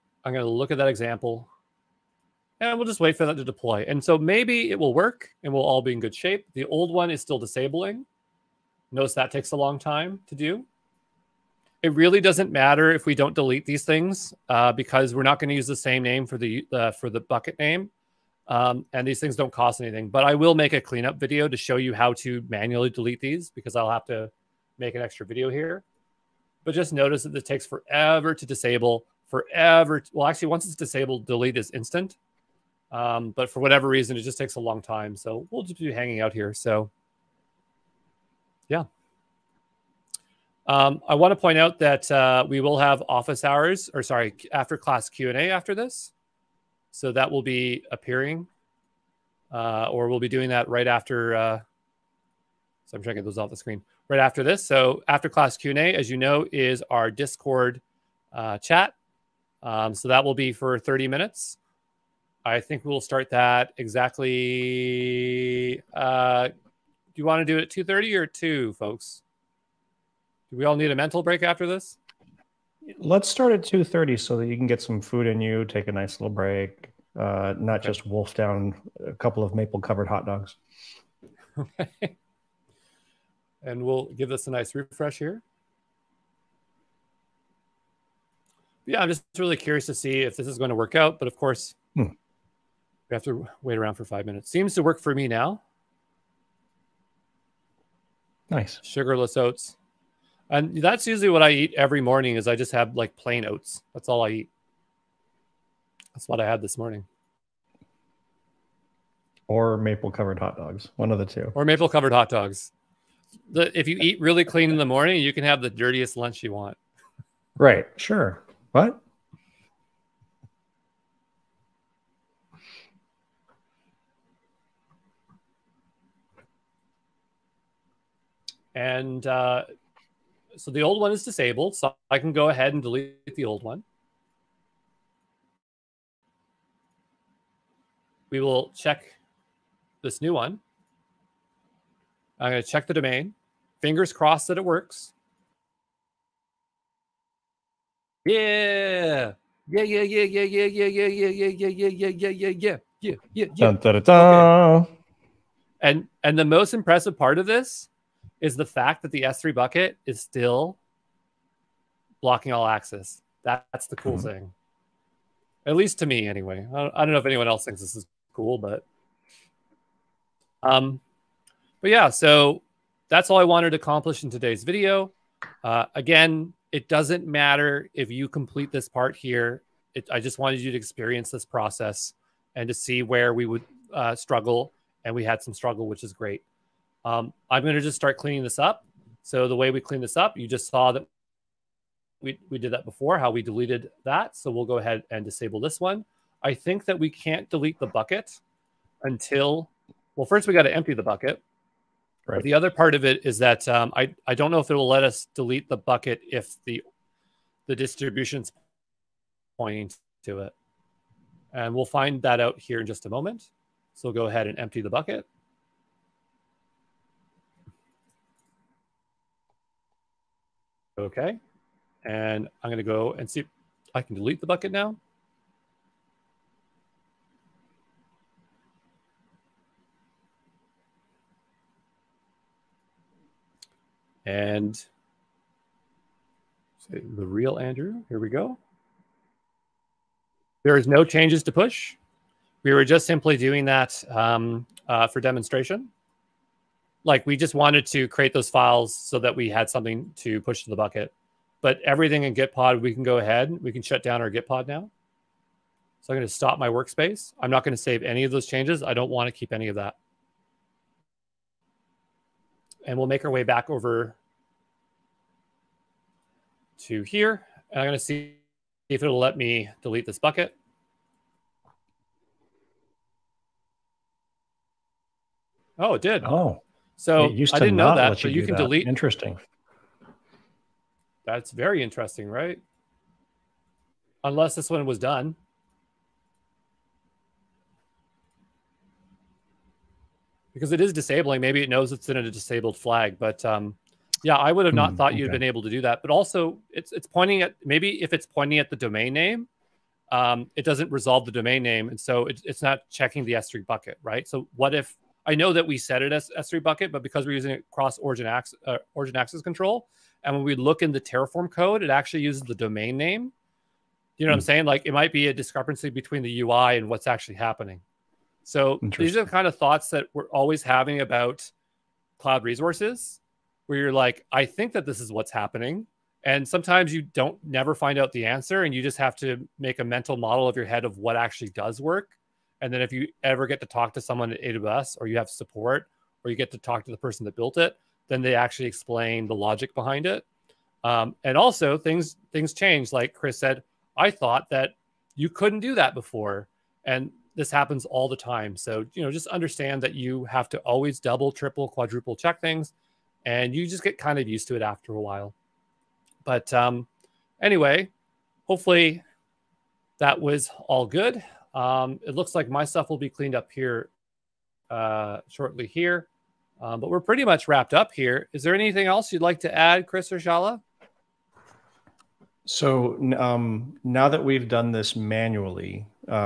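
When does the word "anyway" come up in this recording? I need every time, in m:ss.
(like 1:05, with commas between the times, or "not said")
2:46, 5:57.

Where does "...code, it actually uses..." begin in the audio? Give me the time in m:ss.
5:11.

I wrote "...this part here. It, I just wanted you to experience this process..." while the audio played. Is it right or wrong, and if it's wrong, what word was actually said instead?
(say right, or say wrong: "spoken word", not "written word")
right.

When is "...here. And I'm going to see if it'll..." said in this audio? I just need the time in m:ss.
4:27.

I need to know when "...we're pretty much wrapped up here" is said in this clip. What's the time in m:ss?
6:06.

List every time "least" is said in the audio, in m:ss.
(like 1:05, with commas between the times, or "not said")
2:45.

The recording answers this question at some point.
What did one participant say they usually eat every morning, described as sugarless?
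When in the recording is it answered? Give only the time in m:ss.
1:43.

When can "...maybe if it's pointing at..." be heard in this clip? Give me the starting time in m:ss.
4:57.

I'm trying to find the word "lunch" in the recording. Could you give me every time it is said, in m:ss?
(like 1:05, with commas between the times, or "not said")
1:56.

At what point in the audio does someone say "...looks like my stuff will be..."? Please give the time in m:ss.
6:02.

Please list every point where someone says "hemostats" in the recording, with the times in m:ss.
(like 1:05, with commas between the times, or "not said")
not said.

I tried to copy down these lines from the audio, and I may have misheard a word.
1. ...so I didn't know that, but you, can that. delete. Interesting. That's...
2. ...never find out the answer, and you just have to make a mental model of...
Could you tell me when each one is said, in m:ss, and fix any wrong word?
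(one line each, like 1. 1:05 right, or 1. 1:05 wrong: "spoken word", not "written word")
1. 4:36 right
2. 5:27 right.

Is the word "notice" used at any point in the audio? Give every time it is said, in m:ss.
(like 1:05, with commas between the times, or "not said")
0:08, 0:26.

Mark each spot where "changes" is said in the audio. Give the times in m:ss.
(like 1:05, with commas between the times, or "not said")
4:01, 4:18, 5:42.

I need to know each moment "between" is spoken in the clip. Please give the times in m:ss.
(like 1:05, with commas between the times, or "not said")
5:15.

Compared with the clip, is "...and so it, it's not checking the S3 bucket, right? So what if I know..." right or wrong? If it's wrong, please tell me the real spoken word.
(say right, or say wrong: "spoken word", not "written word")
right.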